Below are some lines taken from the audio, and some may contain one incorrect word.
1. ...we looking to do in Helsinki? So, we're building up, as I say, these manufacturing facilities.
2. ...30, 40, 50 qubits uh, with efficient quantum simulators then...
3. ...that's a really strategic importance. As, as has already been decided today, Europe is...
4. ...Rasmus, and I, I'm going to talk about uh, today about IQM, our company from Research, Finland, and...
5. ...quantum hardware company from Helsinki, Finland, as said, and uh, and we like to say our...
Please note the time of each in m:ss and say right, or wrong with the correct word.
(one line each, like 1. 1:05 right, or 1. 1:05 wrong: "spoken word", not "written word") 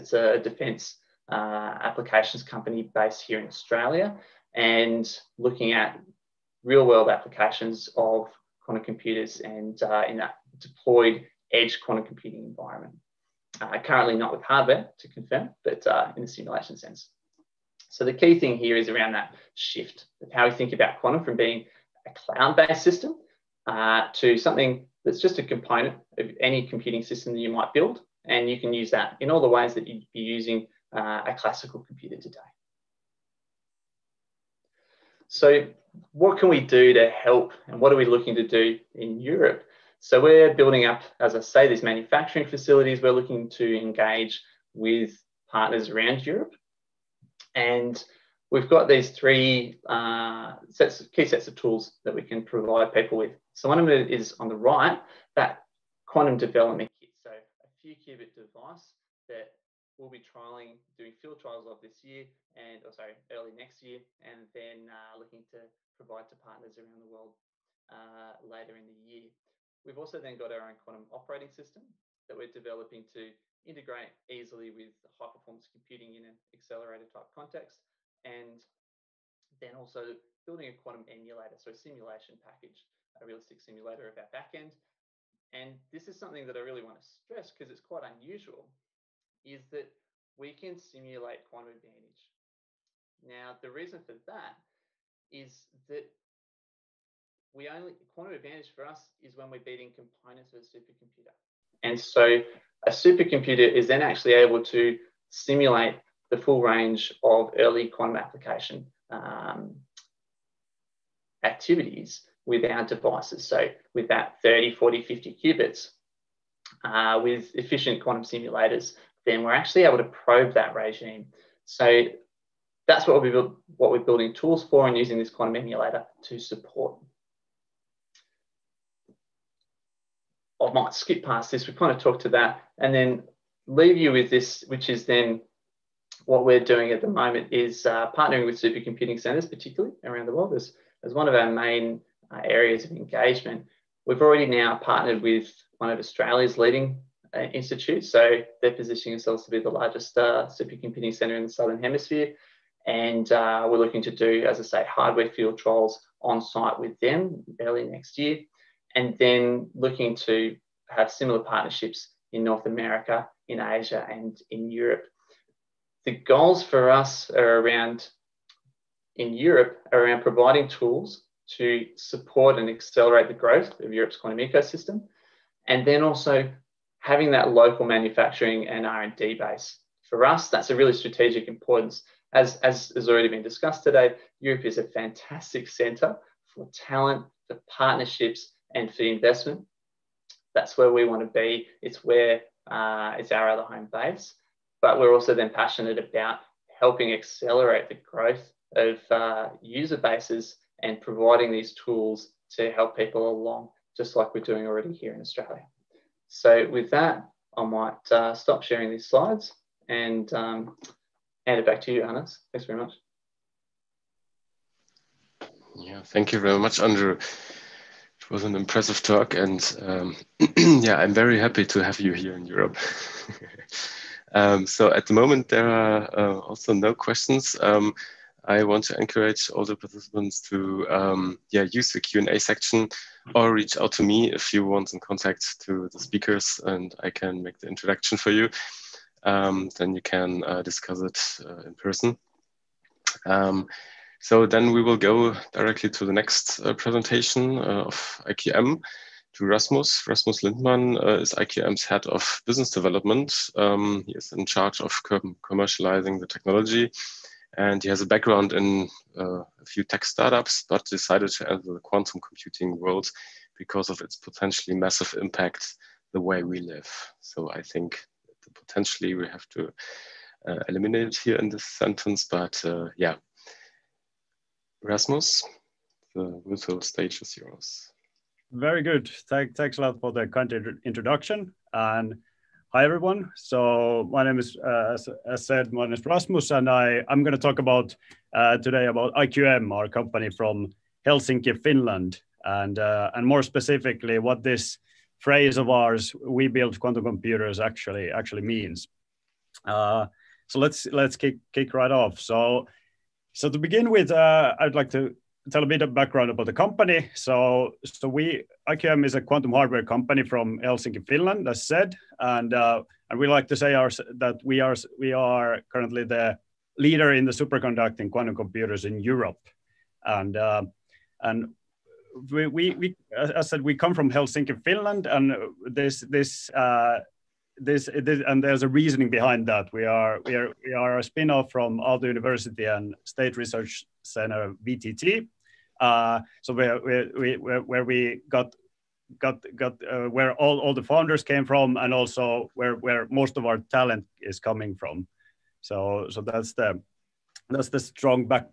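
1. 0:37 wrong: "Europe", not "Helsinki"
2. 1:54 right
3. 3:00 wrong: "discussed", not "decided"
4. 4:46 wrong: "Helsinki", not "Research"
5. 5:09 right.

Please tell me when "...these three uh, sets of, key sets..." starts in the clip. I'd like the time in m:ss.
0:48.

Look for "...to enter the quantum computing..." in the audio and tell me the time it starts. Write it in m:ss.
4:21.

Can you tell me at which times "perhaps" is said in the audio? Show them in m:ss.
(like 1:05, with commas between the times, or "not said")
not said.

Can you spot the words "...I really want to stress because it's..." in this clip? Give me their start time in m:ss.
1:26.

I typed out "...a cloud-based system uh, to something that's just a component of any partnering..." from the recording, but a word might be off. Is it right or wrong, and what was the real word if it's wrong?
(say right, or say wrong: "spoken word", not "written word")
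wrong: "computing", not "partnering".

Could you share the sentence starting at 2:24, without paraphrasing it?
We've already now partnered with one of Australia's leading uh, Institute.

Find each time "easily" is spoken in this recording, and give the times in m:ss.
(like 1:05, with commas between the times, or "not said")
1:14.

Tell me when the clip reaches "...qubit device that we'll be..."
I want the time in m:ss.
0:57.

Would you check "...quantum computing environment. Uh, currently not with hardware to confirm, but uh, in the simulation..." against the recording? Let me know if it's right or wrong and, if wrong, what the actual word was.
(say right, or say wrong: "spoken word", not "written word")
right.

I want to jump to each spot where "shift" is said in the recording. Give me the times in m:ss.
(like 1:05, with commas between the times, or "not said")
0:19.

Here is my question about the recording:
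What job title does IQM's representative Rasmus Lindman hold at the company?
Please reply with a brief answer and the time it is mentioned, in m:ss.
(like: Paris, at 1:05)
head of business development, at 4:11.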